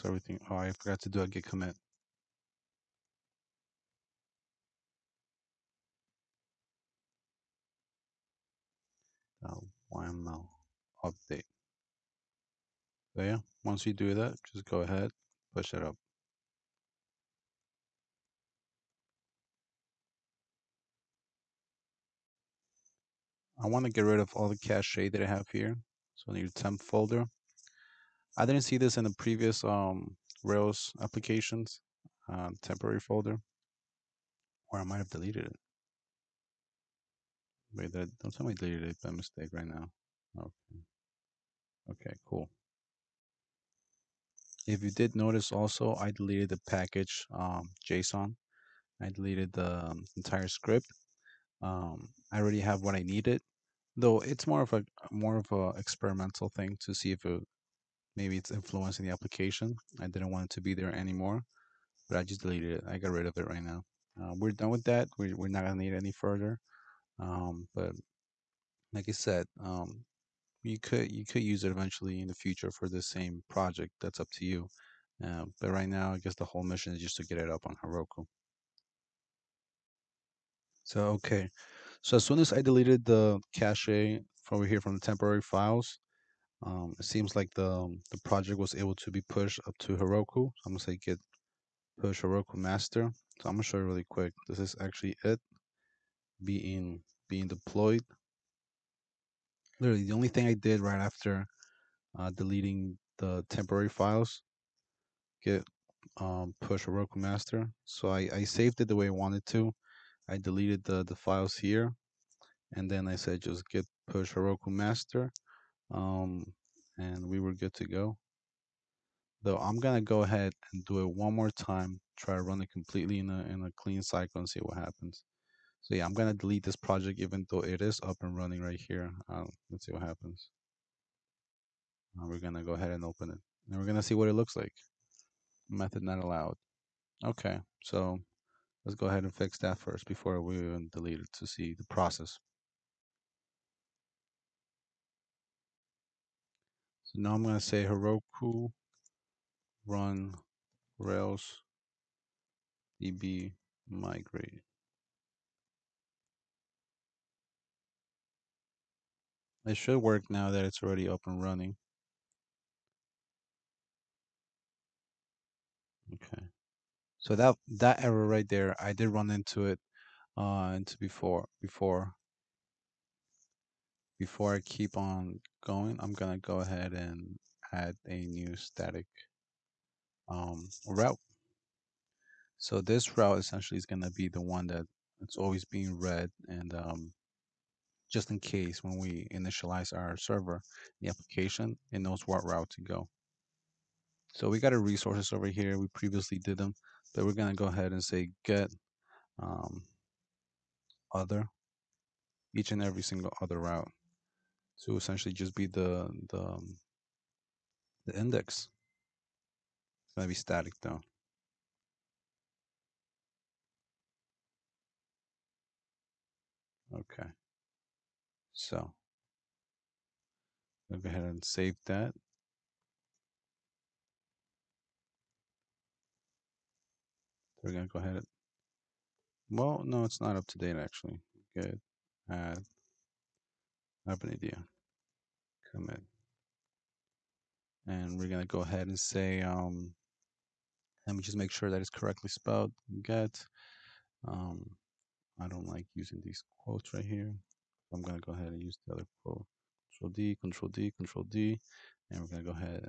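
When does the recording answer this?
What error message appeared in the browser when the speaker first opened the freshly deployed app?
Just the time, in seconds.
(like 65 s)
135 s.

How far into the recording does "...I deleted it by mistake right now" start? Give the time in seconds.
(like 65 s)
38 s.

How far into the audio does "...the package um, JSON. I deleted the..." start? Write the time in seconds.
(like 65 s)
46 s.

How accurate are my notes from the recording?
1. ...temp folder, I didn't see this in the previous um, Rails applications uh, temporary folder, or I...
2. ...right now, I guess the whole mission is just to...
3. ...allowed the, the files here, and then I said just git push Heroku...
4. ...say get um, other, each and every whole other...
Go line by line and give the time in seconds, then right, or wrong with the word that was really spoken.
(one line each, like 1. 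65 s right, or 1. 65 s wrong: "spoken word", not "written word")
1. 26 s right
2. 75 s right
3. 110 s wrong: "deleted", not "allowed"
4. 198 s wrong: "single", not "whole".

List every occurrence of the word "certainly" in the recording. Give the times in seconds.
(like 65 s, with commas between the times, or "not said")
not said.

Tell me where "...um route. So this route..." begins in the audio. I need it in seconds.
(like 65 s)
180 s.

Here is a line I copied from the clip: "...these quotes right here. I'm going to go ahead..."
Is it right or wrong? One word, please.
right.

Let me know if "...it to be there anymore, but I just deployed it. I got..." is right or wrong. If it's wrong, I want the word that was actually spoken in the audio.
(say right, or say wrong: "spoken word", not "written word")
wrong: "deleted", not "deployed".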